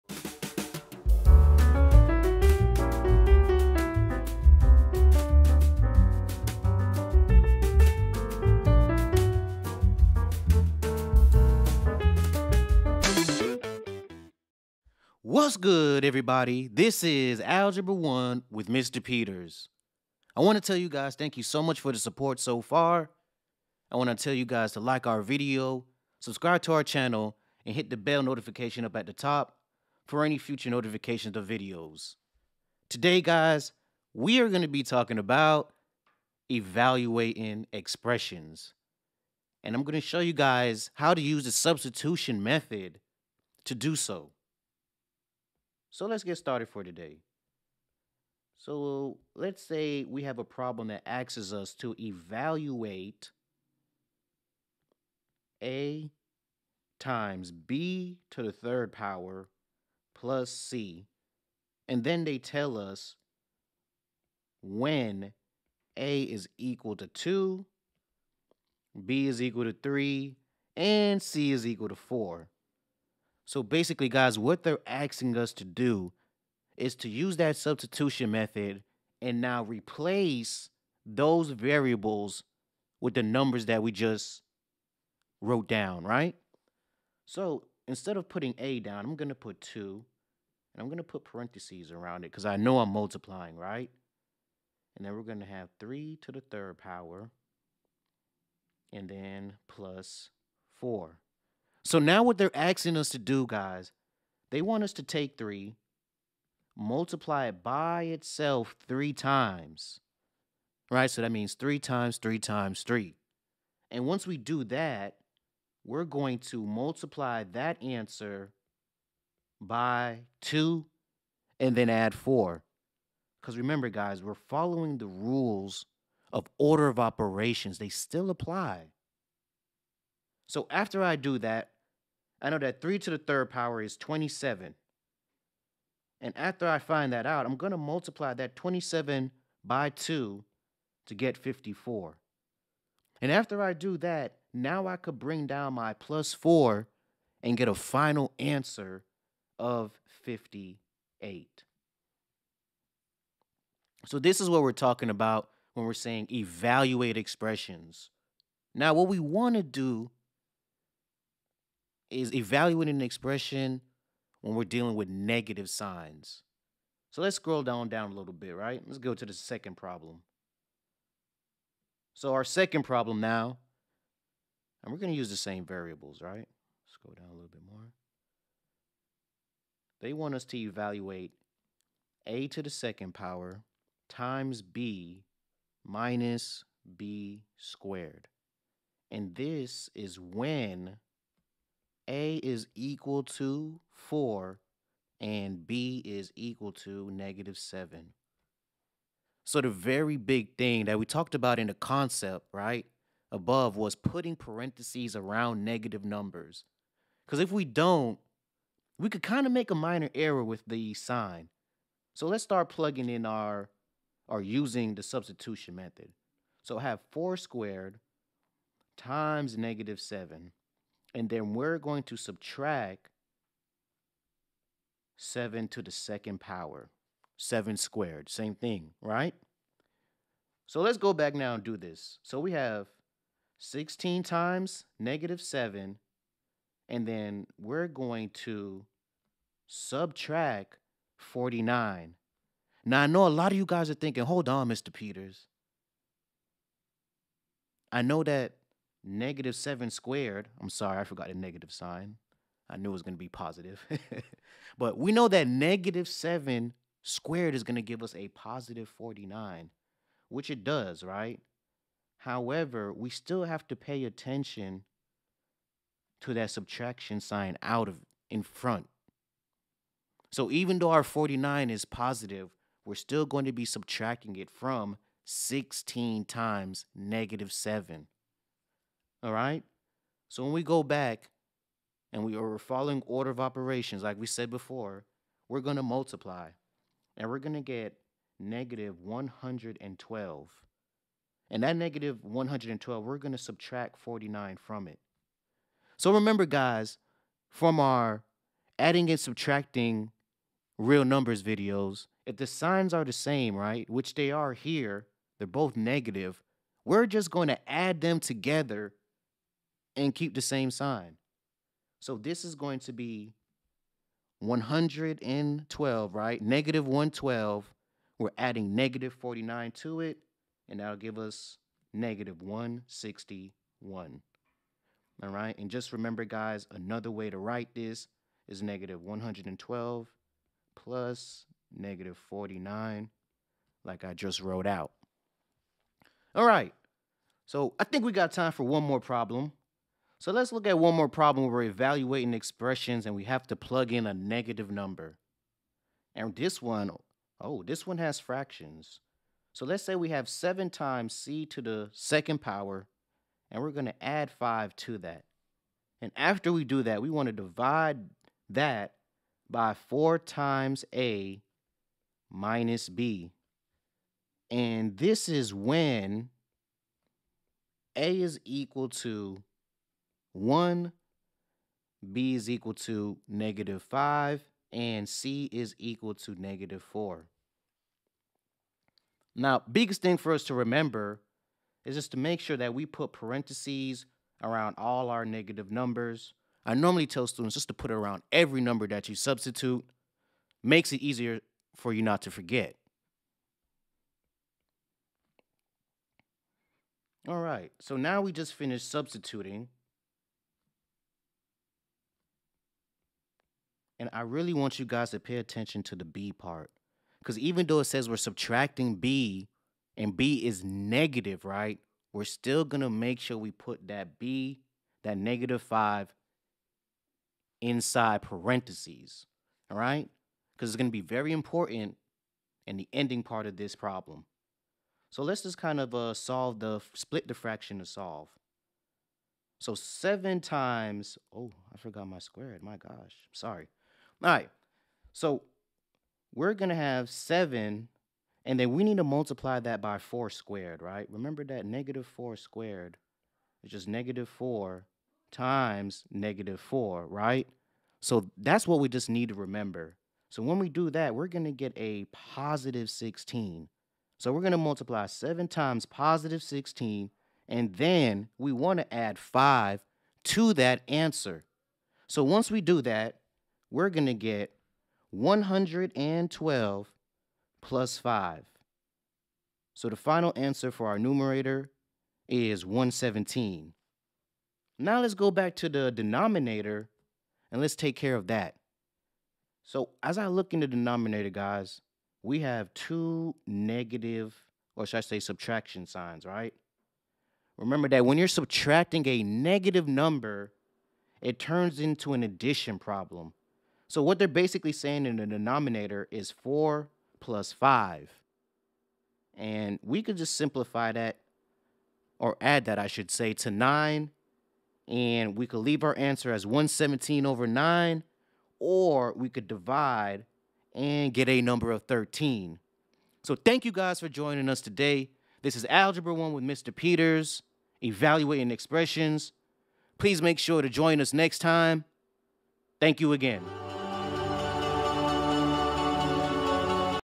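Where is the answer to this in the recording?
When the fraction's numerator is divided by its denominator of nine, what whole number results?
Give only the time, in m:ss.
8:31.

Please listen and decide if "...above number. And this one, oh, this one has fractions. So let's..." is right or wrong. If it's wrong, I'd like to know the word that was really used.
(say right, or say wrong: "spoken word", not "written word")
wrong: "negative", not "above".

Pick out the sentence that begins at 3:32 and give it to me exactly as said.
So let's start plugging in our, or using the substitution method.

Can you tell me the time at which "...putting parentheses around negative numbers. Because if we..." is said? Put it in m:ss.
3:23.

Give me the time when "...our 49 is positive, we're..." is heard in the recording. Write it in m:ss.
4:30.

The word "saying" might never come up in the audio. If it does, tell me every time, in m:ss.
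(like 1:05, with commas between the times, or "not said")
2:35, 8:14.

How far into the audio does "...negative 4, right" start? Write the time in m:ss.
7:26.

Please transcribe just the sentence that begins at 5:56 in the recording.
And after we do that, we want to divide that by 4 times a minus b.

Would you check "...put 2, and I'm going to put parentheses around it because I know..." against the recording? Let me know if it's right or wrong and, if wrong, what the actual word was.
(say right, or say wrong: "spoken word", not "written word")
right.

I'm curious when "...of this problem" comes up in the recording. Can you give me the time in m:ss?
7:03.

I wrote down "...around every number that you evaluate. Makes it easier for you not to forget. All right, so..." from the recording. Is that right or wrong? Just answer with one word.
wrong.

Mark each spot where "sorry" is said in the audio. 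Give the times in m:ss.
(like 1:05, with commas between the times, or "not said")
4:10, 7:13.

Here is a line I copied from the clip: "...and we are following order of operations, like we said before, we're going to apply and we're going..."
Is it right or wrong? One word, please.
wrong.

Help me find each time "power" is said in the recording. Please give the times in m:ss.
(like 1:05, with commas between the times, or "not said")
0:58, 1:36, 2:13, 3:03, 3:46, 5:52.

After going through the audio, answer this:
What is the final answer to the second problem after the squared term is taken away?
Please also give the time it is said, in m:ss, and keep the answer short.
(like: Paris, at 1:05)
-161, at 5:21.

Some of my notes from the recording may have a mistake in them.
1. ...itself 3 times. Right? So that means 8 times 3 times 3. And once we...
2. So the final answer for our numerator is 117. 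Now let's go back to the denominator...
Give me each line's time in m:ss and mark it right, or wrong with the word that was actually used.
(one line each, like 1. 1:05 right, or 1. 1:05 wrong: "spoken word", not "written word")
1. 1:48 wrong: "3", not "8"
2. 7:49 right.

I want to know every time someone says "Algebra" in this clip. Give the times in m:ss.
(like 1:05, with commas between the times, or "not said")
0:17, 8:35.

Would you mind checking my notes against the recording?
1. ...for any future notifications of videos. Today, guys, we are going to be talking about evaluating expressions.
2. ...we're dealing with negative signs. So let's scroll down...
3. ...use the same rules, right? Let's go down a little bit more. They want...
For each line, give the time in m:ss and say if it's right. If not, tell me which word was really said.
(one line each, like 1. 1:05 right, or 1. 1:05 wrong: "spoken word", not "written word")
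1. 0:30 right
2. 2:44 right
3. 2:55 wrong: "variables", not "rules".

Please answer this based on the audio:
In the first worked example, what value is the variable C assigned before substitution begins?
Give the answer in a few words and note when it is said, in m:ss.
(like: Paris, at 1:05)
4, at 1:11.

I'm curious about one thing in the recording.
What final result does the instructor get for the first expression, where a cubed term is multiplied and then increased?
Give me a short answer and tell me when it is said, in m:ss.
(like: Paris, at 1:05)
58, at 2:30.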